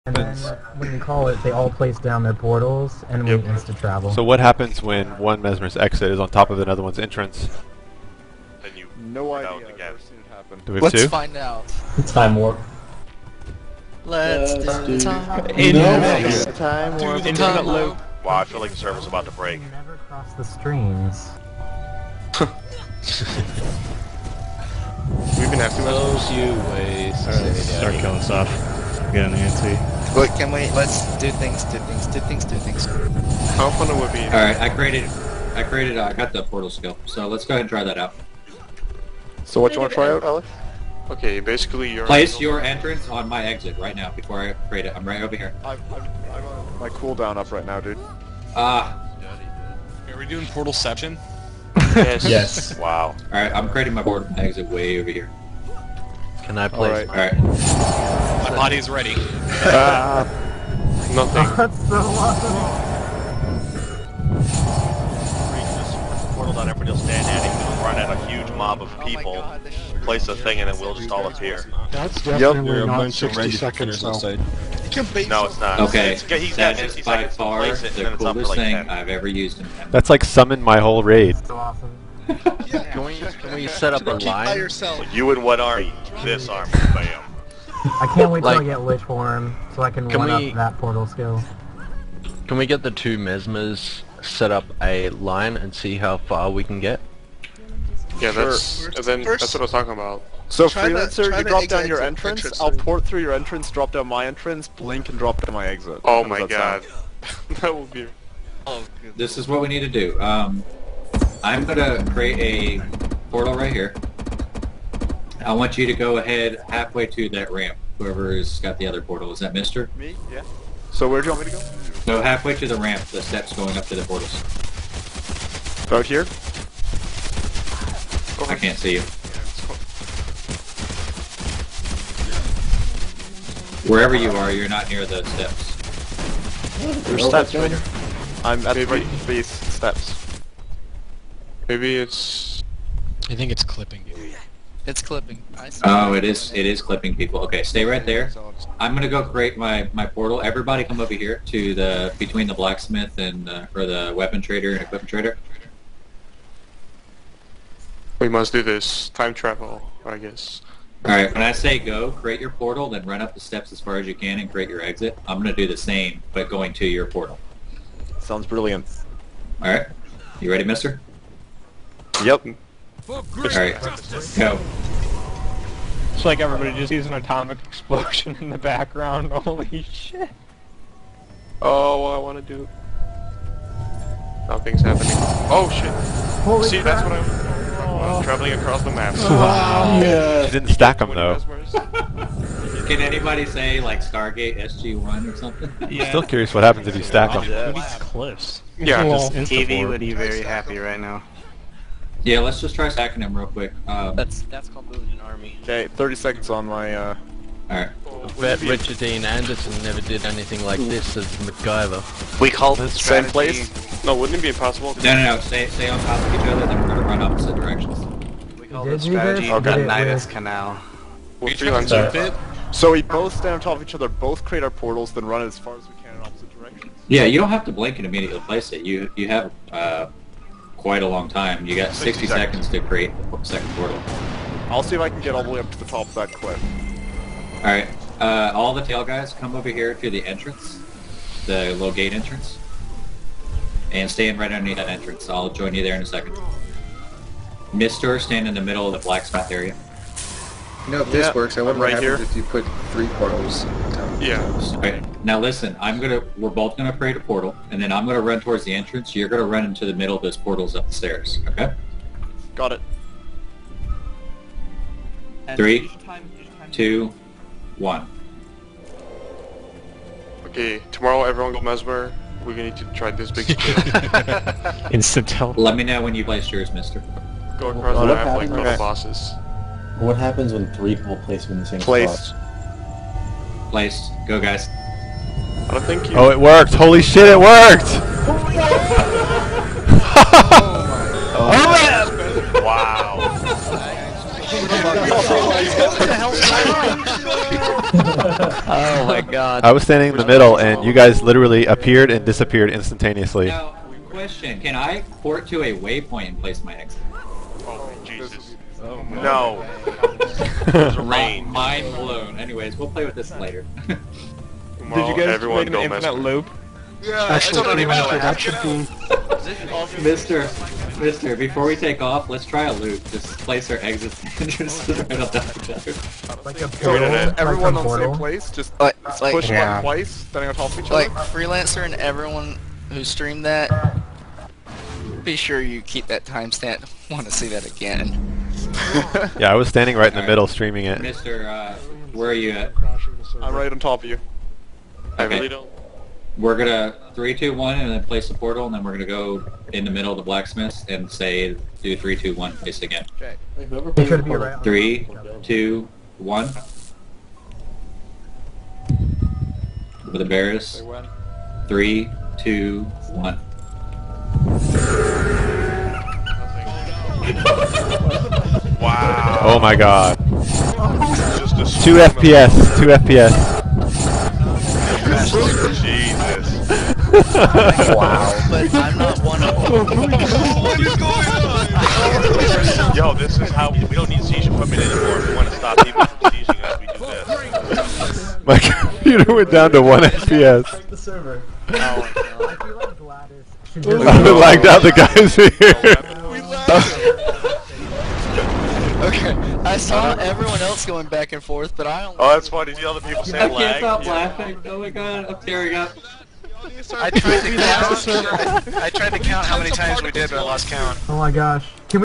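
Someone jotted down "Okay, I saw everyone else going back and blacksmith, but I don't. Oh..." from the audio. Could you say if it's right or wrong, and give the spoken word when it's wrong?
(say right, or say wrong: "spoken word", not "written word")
wrong: "forth", not "blacksmith".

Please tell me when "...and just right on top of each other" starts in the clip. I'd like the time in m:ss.
5:24.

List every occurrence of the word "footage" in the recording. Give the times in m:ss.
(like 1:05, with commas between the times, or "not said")
not said.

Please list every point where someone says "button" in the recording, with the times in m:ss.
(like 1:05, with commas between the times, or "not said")
not said.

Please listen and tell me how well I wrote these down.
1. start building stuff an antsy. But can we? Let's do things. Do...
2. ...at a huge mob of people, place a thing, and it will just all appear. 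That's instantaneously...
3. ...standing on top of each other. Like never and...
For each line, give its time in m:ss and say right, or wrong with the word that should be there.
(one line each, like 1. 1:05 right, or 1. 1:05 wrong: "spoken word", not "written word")
1. 0:27 wrong: "killing", not "building"
2. 1:07 wrong: "definitely", not "instantaneously"
3. 5:30 wrong: "freelancer", not "never".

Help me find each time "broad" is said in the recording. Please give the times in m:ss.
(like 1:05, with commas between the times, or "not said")
not said.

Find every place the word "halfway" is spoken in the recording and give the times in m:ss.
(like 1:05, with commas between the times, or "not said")
1:56, 2:02.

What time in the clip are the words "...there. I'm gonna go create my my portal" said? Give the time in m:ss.
2:28.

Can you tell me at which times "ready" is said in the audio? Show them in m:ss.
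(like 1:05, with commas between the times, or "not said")
0:58, 2:50.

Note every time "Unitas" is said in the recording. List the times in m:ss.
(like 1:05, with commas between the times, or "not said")
3:39.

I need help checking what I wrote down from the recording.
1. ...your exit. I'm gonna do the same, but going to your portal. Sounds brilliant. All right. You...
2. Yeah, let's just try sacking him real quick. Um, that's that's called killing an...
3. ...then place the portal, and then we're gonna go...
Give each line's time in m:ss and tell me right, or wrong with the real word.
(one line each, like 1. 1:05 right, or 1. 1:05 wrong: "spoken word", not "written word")
1. 2:44 right
2. 3:22 wrong: "building", not "killing"
3. 5:47 right.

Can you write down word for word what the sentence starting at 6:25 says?
we want to stop people from sieging us, we do this.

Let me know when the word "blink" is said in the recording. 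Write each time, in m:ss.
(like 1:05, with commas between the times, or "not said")
1:44, 3:47.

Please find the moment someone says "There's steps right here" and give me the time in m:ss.
2:17.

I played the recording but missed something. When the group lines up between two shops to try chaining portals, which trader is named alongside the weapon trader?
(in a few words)
equipment trader.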